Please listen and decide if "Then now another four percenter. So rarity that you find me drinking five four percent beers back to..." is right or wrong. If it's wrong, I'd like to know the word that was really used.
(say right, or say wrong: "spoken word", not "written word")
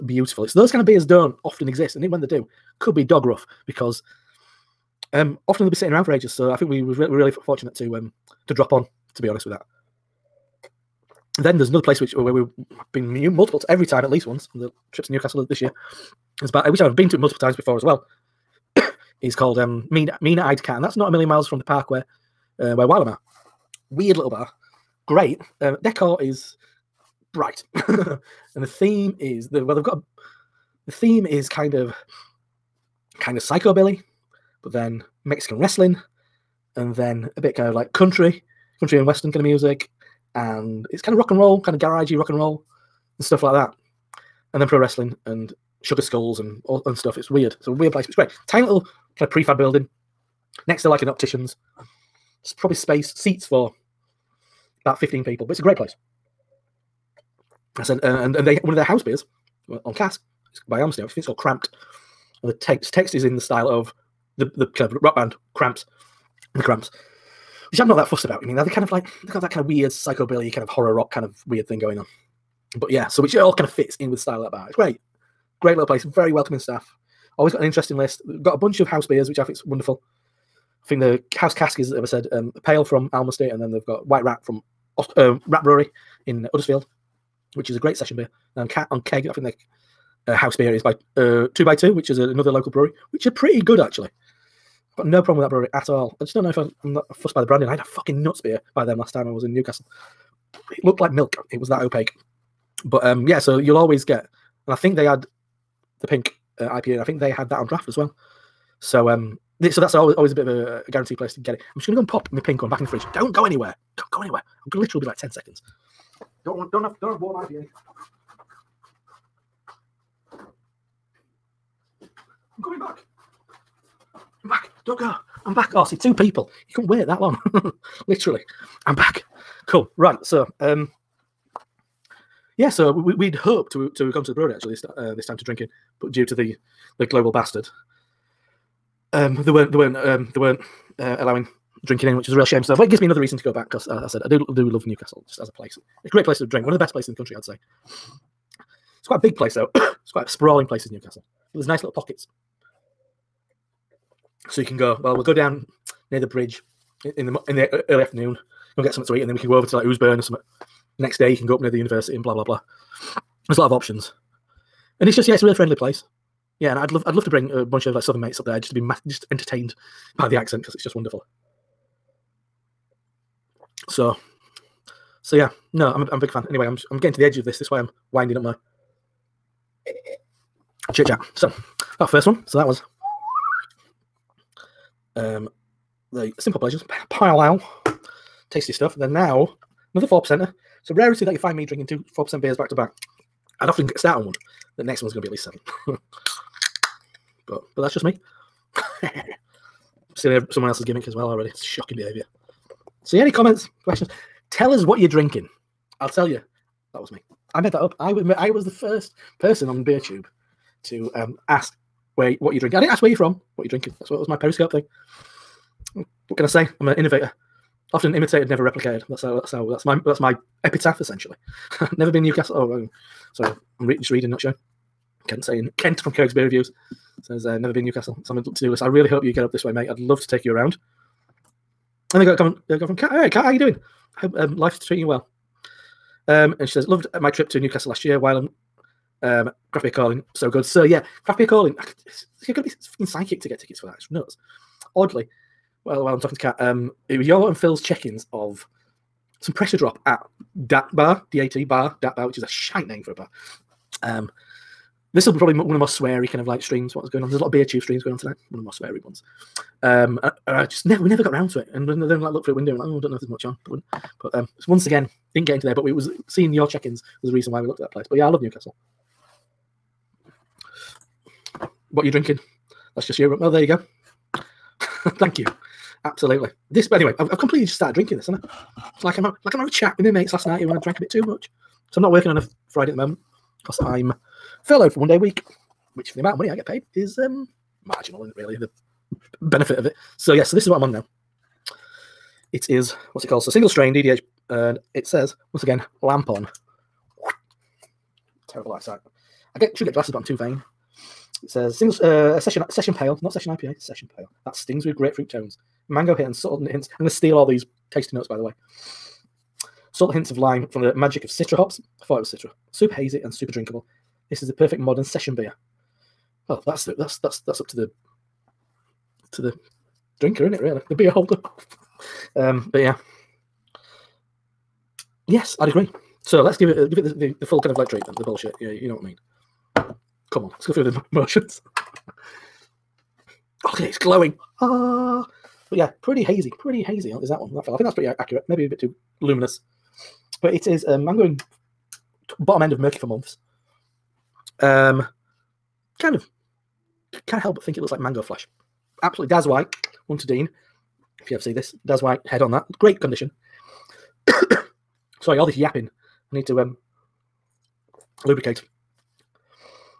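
wrong: "two", not "five".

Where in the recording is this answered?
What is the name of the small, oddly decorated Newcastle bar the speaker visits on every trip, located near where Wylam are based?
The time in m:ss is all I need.
0:19.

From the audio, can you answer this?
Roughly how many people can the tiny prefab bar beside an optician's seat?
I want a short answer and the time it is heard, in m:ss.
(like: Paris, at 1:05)
15, at 0:54.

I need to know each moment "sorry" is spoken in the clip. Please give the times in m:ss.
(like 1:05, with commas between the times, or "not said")
3:43, 5:55.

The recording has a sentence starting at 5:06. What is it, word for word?
I'm gonna steal all these tasty notes, by the way.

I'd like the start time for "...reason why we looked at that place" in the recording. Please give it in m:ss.
4:27.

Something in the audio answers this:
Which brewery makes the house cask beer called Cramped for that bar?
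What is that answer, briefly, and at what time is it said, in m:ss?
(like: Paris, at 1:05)
Almasty, at 1:00.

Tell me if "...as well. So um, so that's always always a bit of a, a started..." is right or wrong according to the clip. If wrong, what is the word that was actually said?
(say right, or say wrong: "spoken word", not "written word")
wrong: "guaranteed", not "started".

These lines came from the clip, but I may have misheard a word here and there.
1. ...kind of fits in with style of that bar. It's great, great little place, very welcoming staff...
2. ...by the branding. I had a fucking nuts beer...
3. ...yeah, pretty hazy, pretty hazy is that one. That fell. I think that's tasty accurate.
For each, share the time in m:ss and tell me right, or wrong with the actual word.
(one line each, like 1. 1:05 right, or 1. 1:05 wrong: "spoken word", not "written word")
1. 1:13 right
2. 1:37 right
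3. 5:35 wrong: "pretty", not "tasty".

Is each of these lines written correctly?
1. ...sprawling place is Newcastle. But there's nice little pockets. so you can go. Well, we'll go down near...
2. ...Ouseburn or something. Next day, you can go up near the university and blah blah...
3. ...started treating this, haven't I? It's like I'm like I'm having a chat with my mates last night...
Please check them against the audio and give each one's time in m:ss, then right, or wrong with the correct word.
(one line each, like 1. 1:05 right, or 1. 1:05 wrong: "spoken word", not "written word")
1. 2:30 right
2. 2:39 right
3. 4:37 wrong: "drinking", not "treating".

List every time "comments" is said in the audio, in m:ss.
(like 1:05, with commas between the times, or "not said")
3:23, 3:52.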